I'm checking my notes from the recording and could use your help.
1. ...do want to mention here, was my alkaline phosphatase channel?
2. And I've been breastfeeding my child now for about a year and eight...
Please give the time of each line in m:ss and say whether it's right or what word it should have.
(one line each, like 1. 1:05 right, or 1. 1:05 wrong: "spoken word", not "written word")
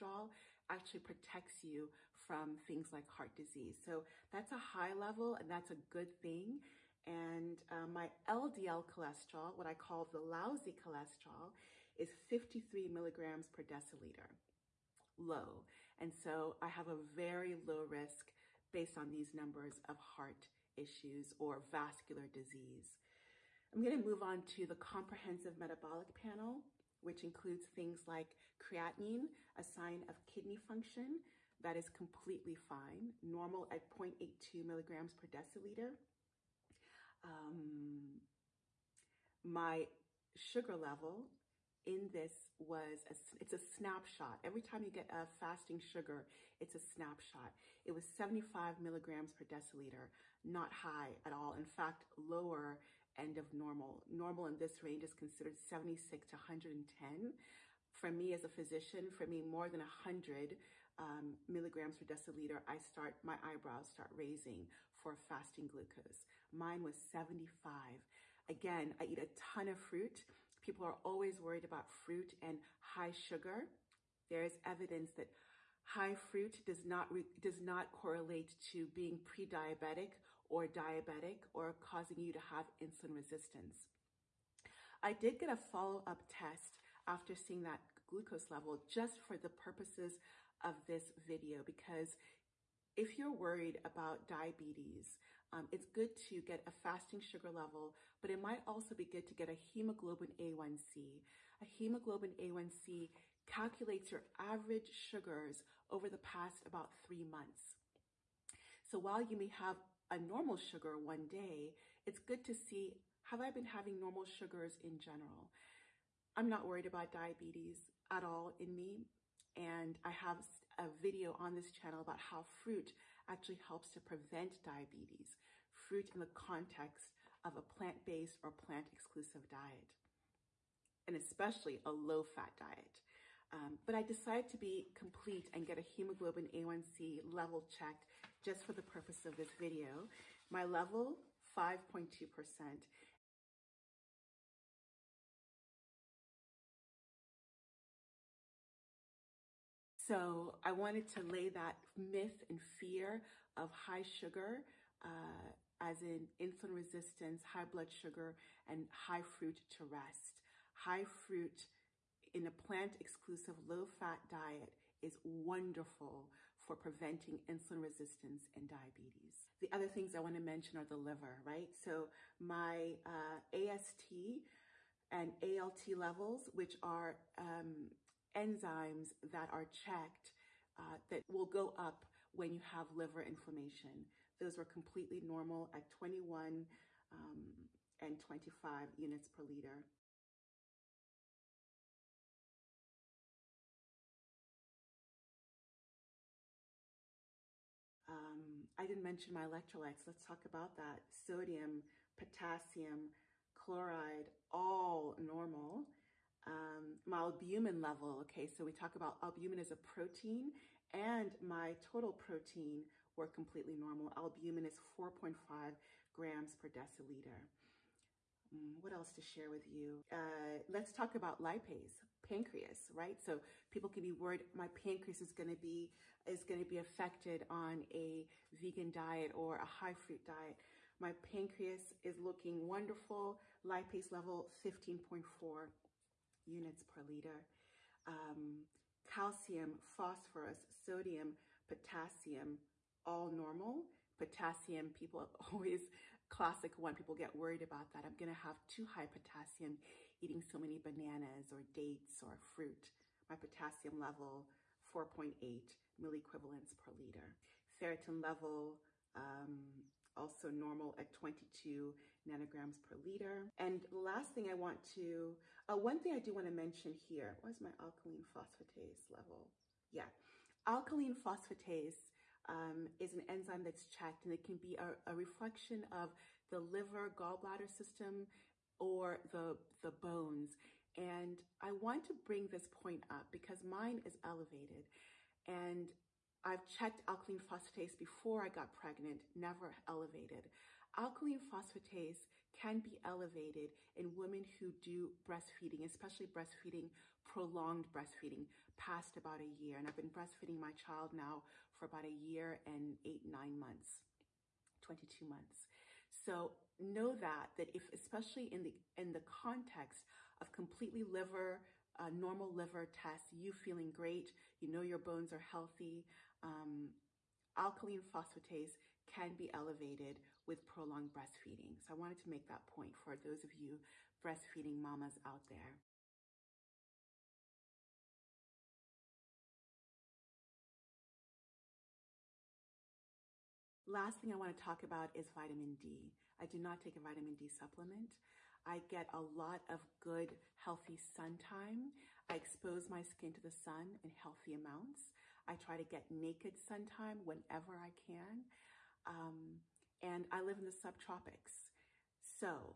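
1. 4:26 wrong: "level", not "channel"
2. 4:59 right.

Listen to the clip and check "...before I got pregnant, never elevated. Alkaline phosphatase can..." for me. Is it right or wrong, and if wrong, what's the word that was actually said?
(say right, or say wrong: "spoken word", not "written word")
right.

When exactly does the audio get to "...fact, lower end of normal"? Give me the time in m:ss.
0:51.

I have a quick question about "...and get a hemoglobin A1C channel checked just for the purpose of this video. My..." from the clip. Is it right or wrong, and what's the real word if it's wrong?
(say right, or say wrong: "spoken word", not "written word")
wrong: "level", not "channel".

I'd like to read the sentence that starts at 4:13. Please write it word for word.
My potassium level, 4.8 milliequivalents per liter.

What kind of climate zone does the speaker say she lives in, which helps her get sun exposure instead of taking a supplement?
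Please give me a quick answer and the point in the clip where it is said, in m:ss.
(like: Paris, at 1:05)
subtropics, at 5:50.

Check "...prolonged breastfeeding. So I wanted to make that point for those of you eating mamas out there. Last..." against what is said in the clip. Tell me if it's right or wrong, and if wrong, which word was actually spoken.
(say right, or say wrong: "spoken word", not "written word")
wrong: "breastfeeding", not "eating".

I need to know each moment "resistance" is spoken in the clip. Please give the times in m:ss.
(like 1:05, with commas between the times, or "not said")
1:23, 2:36, 2:47.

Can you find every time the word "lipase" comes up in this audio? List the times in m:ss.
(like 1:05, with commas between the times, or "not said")
3:41, 3:53.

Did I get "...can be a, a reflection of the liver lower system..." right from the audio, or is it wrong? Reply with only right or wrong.
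wrong.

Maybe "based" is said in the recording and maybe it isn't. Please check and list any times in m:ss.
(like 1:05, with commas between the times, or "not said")
0:18, 2:07.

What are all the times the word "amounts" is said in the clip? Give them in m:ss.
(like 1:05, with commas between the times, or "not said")
5:44.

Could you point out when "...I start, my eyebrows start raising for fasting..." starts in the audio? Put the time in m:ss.
1:02.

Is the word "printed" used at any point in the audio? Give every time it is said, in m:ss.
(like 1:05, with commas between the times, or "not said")
not said.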